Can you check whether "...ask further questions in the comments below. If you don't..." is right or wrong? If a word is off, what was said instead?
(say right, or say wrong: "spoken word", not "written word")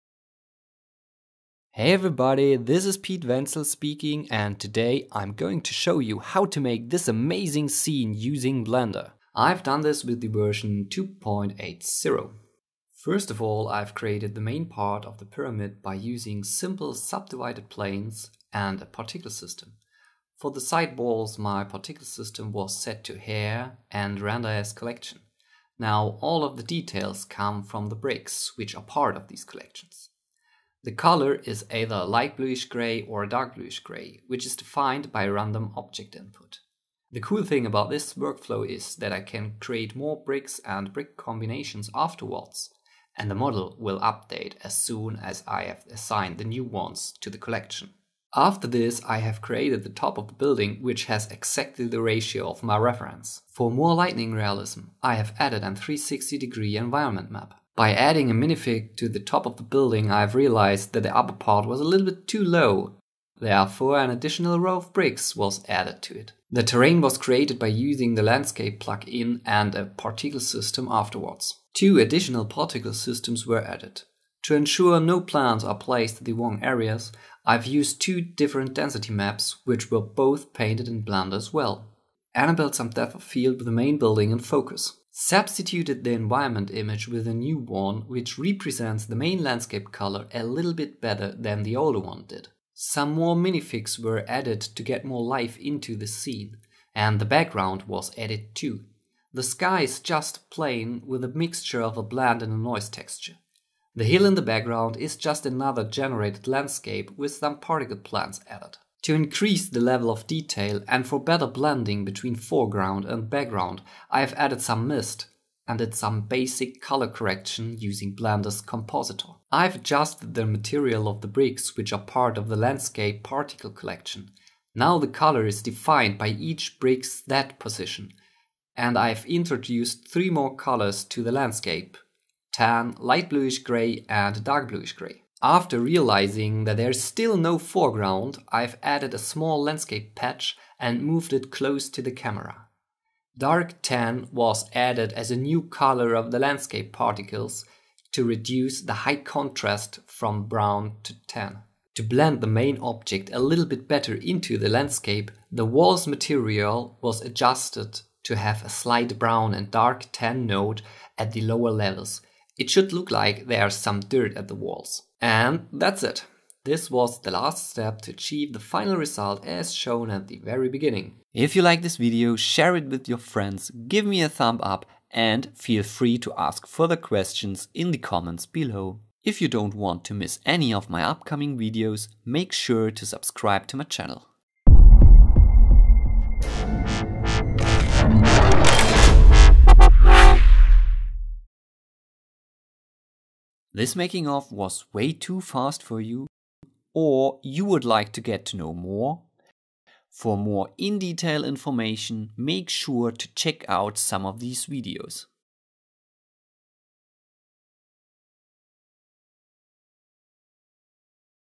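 right.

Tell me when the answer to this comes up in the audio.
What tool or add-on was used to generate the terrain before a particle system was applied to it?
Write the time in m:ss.
1:08.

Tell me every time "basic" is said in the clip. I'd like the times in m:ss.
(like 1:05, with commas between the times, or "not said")
1:56.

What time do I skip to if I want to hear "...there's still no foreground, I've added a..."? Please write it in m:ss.
2:16.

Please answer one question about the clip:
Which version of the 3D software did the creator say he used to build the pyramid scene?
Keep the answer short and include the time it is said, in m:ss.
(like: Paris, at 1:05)
2.80, at 0:10.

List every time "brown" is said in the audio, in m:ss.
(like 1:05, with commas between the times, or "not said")
2:30, 2:39.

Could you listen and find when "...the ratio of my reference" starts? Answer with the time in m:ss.
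0:51.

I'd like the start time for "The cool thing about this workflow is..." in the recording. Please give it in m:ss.
0:37.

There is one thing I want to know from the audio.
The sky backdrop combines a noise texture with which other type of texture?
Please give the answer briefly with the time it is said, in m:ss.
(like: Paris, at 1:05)
blend, at 1:42.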